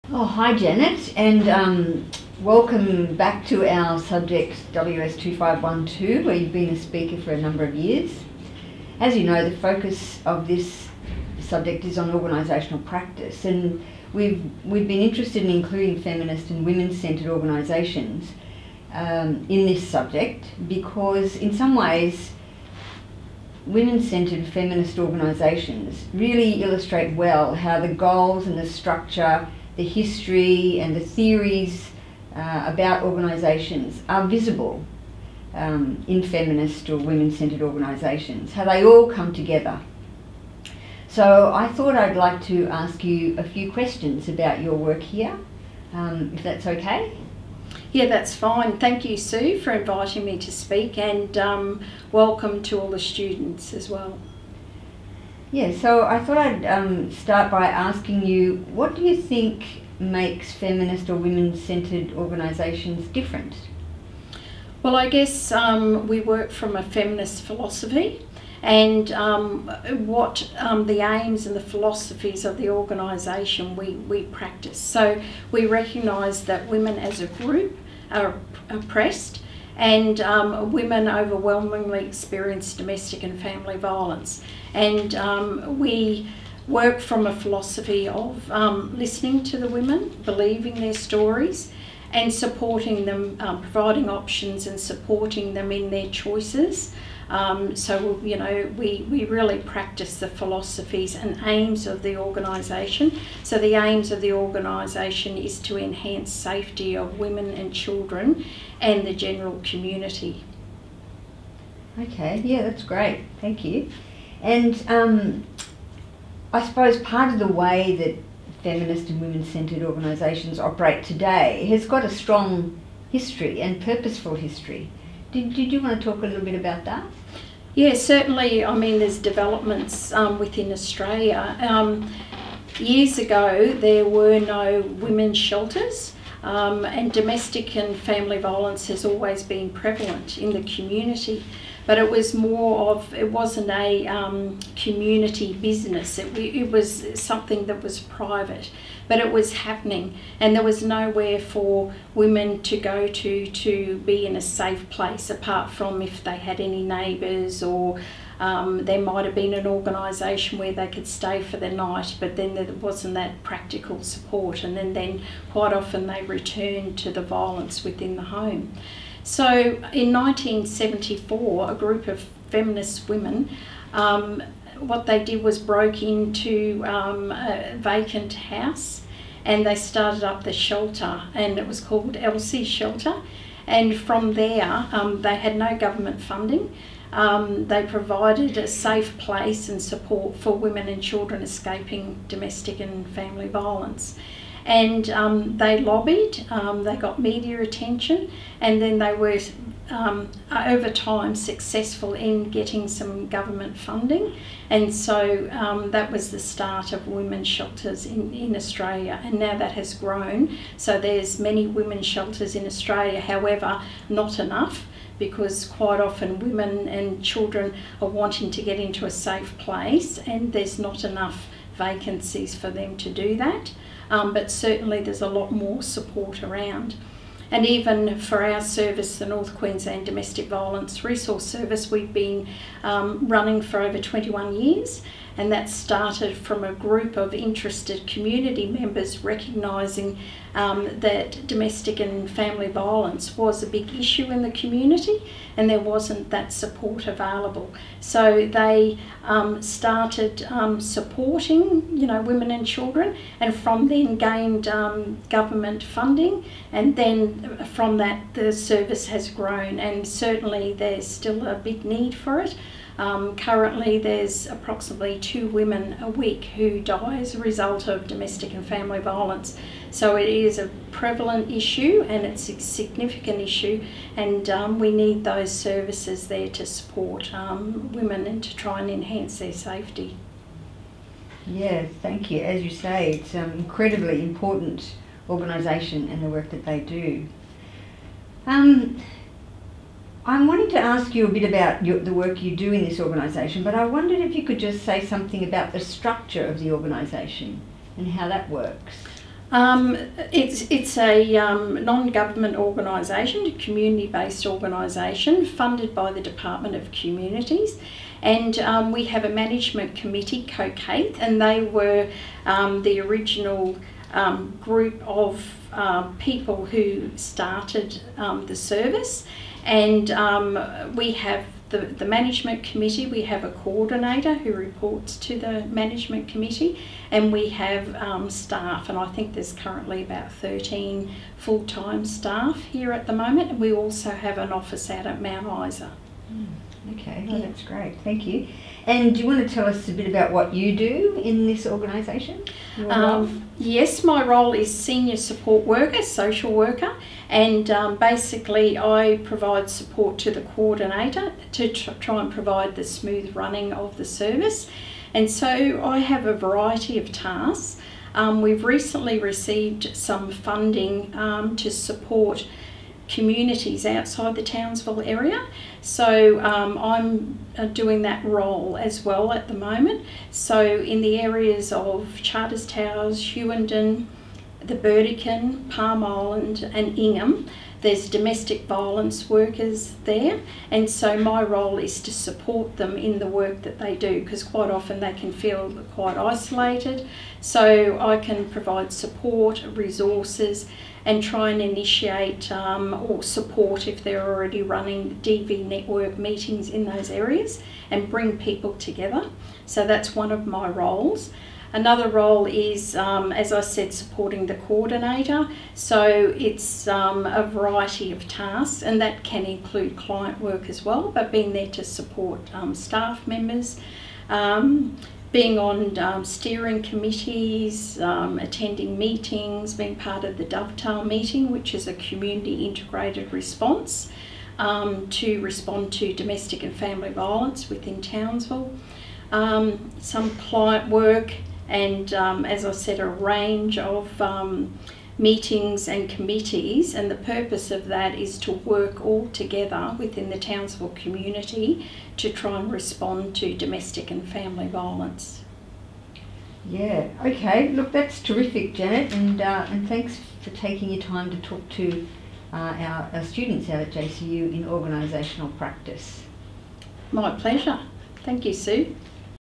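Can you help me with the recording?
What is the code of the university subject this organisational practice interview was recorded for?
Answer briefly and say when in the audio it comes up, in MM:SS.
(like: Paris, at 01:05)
WS2512, at 00:04.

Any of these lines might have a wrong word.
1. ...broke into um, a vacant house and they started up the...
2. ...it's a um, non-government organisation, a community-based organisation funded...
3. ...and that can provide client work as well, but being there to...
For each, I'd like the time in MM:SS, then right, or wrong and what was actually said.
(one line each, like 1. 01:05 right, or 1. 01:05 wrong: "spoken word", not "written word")
1. 02:55 right
2. 05:00 right
3. 06:48 wrong: "include", not "provide".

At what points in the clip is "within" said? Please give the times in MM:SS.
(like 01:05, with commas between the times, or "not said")
02:10, 02:47, 07:07, 07:19.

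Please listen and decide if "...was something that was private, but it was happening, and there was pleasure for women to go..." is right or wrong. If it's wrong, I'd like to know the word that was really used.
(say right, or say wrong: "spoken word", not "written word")
wrong: "nowhere", not "pleasure".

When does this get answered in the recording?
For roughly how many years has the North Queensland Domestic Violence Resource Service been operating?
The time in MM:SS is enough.
03:53.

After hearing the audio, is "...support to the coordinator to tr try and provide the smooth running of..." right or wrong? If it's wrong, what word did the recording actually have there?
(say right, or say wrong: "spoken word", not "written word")
right.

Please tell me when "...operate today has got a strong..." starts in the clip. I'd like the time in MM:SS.
02:00.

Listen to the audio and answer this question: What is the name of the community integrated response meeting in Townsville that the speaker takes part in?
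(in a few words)
Dovetail.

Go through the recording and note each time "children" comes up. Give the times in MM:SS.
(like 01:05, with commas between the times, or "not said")
01:47, 03:11, 03:37, 04:12.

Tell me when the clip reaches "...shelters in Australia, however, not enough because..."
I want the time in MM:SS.
03:32.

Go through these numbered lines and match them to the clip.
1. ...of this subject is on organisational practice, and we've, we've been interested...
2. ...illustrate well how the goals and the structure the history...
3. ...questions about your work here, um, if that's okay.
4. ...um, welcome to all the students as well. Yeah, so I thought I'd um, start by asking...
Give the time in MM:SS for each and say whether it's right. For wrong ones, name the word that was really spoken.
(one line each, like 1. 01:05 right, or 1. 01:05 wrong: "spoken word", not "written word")
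1. 00:10 right
2. 00:26 right
3. 00:43 right
4. 00:51 right.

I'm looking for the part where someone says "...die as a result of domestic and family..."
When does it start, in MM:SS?
04:26.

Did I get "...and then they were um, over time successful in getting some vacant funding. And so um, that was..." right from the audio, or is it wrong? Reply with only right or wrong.
wrong.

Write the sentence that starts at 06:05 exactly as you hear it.
So um, I'm uh, doing that role as well at the moment.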